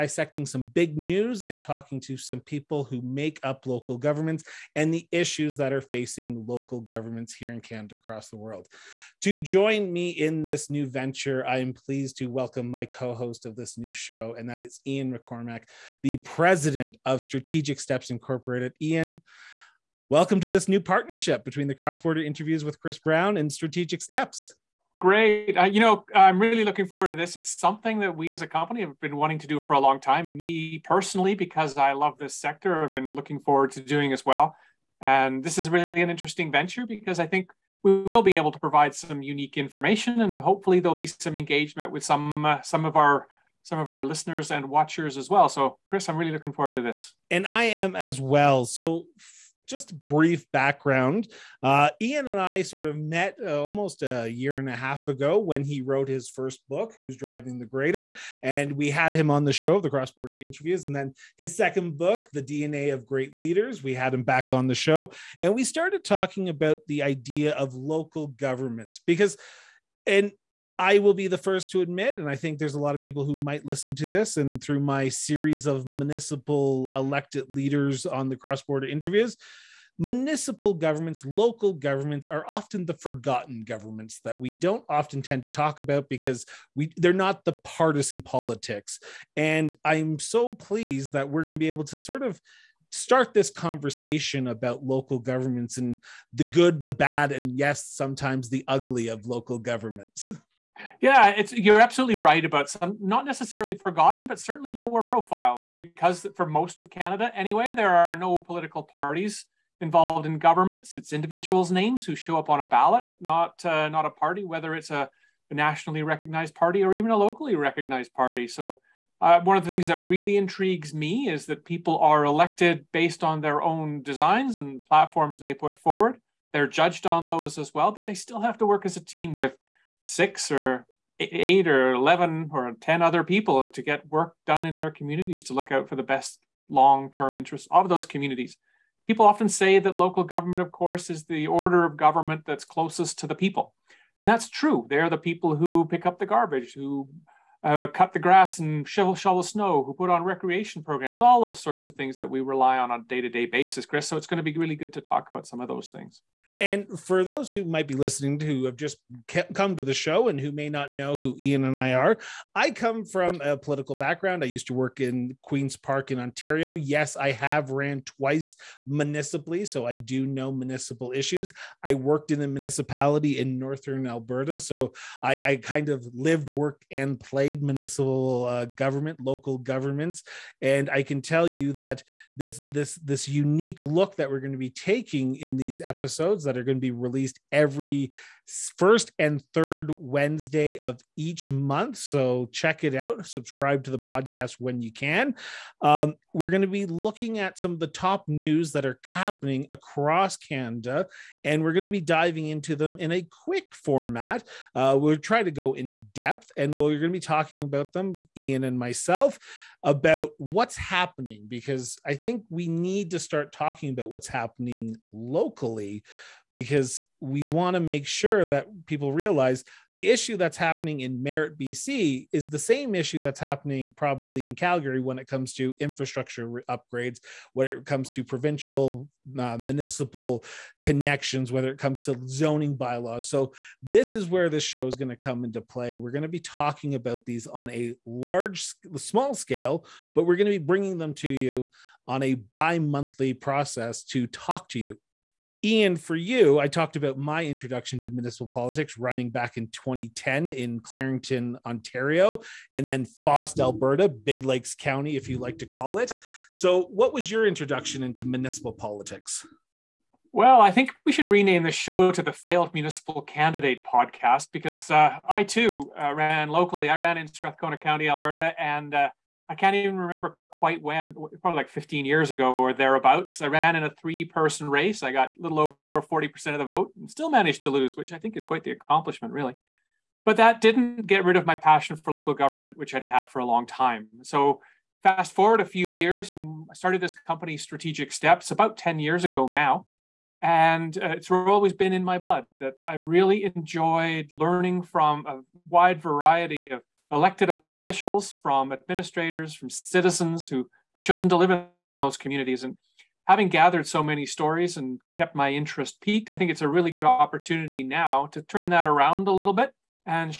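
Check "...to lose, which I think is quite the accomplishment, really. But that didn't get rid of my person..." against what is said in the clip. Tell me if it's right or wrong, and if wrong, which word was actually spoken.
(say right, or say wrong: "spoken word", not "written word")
wrong: "passion", not "person".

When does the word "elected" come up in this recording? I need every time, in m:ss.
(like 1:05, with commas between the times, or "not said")
1:16, 2:02, 4:57.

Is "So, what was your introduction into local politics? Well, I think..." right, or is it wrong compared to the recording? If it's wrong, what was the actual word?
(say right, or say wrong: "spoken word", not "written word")
wrong: "municipal", not "local".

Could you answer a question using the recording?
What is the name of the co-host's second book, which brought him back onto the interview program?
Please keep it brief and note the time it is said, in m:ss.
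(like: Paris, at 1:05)
The DNA of Great Leaders, at 1:02.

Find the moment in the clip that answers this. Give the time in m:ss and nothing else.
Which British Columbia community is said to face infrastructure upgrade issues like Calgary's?
3:41.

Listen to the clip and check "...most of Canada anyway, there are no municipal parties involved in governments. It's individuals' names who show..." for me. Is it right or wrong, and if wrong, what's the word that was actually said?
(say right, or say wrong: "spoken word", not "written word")
wrong: "political", not "municipal".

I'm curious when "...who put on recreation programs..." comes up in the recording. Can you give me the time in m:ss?
2:29.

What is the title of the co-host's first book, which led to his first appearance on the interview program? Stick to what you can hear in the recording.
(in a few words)
Who's Driving the Grader?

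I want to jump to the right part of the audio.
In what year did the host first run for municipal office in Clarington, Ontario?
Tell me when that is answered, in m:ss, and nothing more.
4:09.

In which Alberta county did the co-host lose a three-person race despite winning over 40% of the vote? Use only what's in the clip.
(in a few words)
Strathcona County.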